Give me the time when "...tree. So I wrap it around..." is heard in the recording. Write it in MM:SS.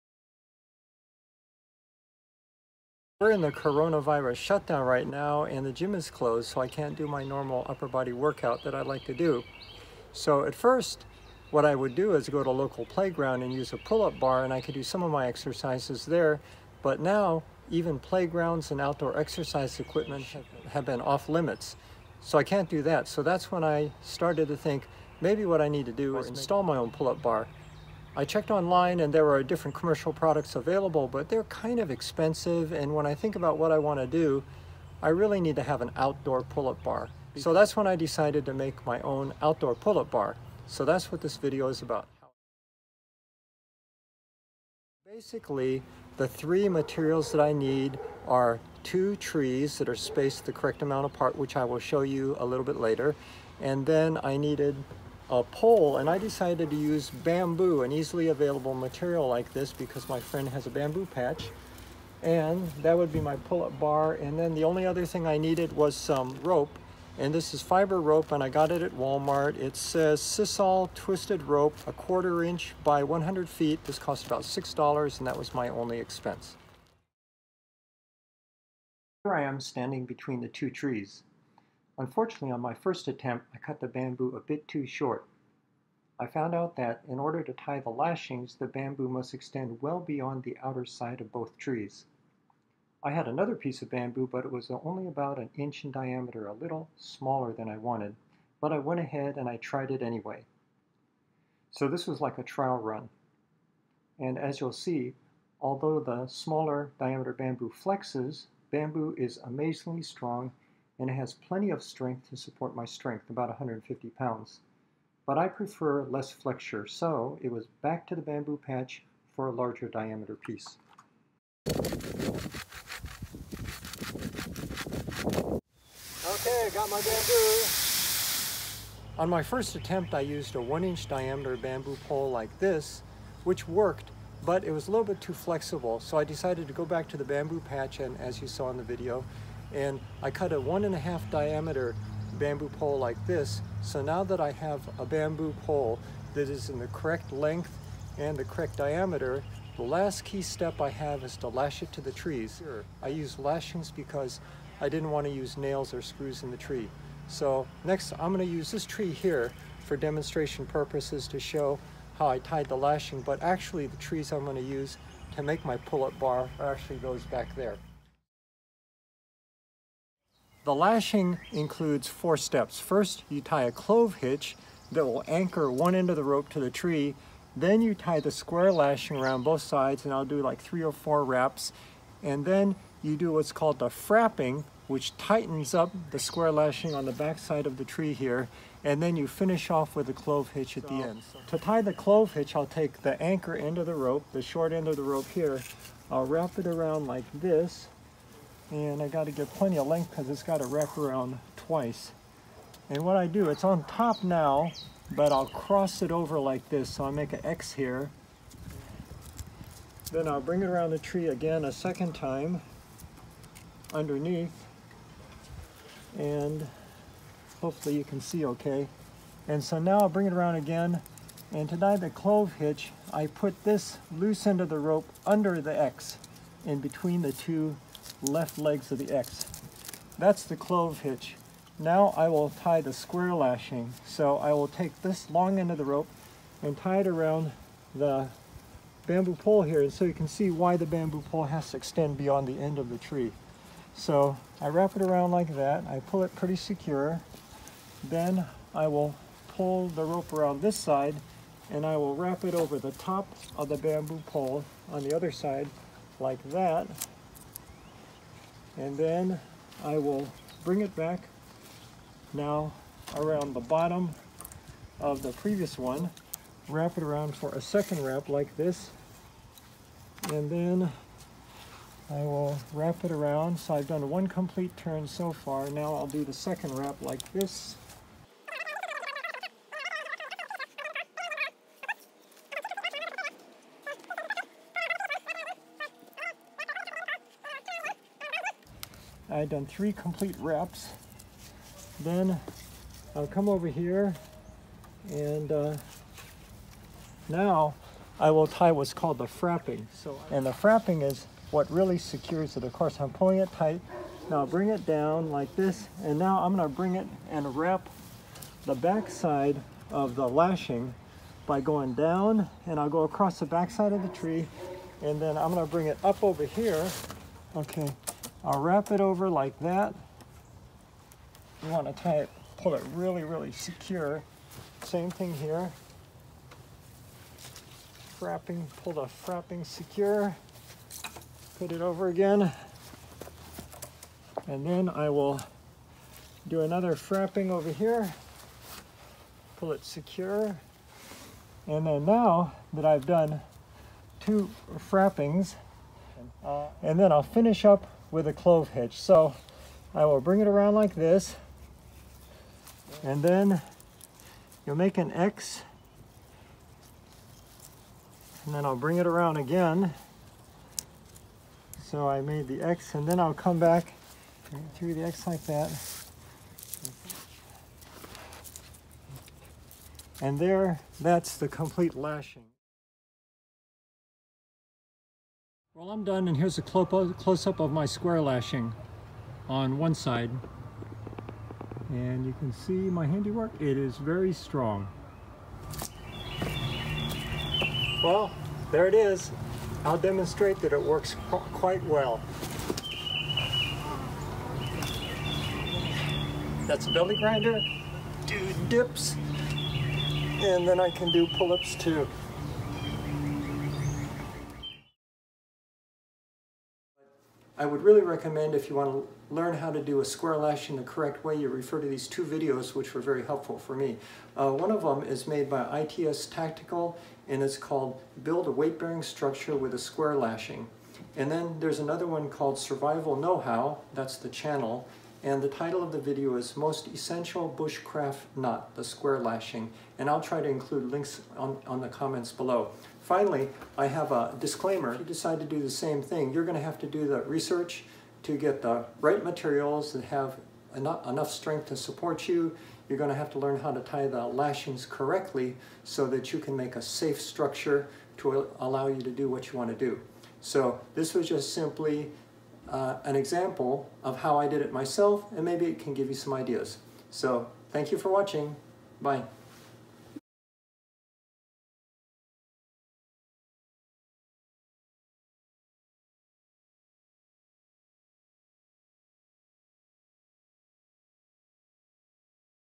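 04:02.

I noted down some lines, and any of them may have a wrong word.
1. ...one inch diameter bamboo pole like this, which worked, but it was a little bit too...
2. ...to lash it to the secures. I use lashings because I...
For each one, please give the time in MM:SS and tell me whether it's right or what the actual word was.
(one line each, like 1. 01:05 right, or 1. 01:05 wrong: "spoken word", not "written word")
1. 02:10 right
2. 02:31 wrong: "trees", not "secures".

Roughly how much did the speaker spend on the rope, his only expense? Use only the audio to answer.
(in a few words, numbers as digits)
$6.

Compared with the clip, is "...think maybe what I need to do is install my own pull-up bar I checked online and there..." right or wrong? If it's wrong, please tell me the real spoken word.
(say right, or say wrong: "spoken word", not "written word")
right.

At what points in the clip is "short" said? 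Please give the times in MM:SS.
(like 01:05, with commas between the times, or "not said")
01:24, 03:14.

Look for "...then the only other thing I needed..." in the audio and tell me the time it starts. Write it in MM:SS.
01:04.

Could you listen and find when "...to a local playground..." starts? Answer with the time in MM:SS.
00:12.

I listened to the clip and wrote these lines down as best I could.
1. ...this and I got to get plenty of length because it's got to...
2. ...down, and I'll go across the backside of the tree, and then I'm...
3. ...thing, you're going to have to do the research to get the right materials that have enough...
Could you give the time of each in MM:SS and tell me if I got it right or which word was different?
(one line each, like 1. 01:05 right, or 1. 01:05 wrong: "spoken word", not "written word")
1. 03:17 right
2. 05:11 right
3. 07:16 right.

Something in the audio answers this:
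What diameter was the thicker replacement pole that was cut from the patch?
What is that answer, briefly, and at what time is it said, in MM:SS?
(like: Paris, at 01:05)
one and a half, at 02:20.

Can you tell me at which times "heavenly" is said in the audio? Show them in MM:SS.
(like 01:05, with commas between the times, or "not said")
not said.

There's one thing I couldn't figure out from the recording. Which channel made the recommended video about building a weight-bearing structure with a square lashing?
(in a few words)
ITS Tactical.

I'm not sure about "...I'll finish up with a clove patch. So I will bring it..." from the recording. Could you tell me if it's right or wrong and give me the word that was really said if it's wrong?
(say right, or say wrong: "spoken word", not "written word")
wrong: "hitch", not "patch".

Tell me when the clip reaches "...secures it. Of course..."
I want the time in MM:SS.
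05:01.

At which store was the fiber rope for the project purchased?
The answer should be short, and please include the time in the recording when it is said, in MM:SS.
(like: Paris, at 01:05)
Walmart, at 01:08.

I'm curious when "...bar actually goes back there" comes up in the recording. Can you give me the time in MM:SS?
02:46.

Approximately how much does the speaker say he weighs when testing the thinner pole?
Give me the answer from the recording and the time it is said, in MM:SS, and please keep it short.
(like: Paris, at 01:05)
150 pounds, at 01:53.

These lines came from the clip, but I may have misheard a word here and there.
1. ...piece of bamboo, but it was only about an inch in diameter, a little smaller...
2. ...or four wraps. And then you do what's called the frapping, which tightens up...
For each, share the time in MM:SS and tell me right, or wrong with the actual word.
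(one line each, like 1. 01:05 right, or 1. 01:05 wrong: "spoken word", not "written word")
1. 01:33 right
2. 03:00 right.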